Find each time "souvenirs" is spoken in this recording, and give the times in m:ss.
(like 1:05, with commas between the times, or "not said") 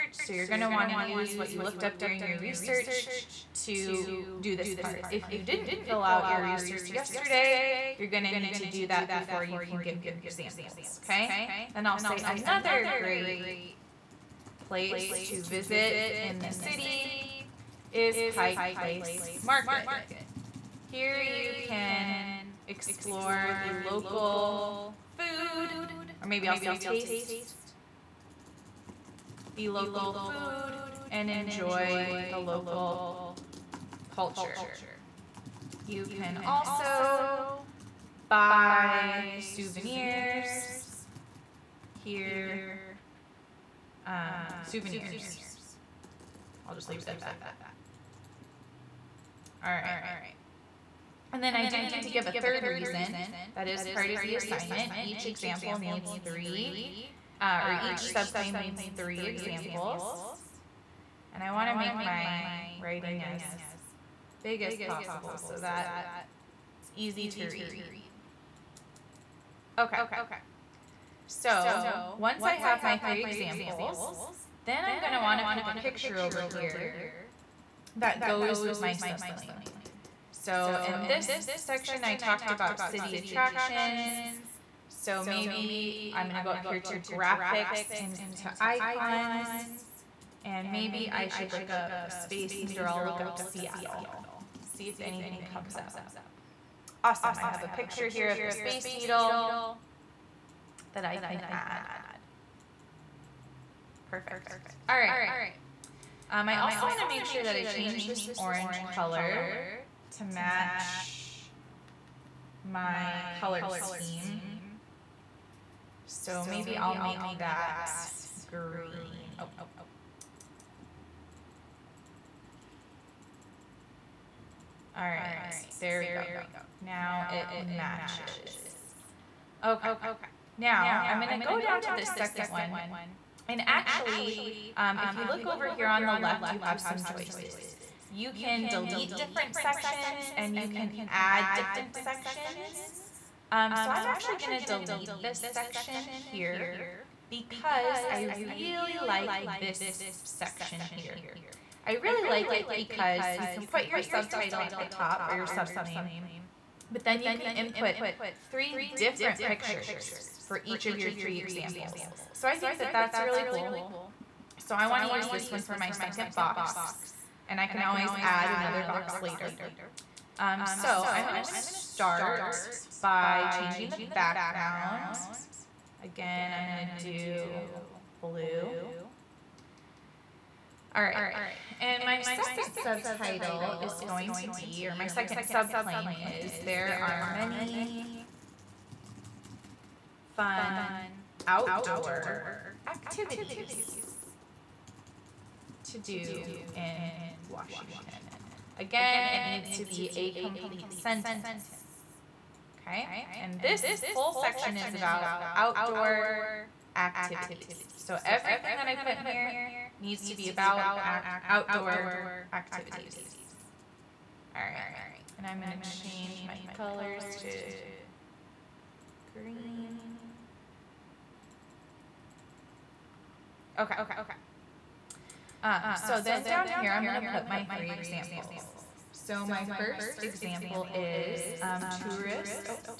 0:39, 0:44.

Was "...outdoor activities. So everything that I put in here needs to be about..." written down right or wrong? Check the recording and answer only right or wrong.
right.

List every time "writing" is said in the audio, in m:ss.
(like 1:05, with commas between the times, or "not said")
1:02.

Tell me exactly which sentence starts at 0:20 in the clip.
Here you can explore the local food, or maybe I'll say taste the local food and enjoy the local culture.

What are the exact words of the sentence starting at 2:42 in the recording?
So I think that that's really cool.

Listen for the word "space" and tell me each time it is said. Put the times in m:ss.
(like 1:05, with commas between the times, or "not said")
1:32, 1:38.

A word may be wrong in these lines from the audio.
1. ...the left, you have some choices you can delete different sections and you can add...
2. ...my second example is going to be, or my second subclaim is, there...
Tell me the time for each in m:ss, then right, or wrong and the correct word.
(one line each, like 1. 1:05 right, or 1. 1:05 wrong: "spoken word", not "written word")
1. 2:16 right
2. 3:02 wrong: "subtitle", not "example".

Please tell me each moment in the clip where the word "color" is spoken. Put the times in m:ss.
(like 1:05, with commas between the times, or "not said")
1:48, 1:53, 3:36.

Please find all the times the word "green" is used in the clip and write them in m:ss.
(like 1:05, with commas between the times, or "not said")
1:58, 3:39.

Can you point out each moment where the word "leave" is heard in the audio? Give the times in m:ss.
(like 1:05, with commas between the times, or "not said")
0:46.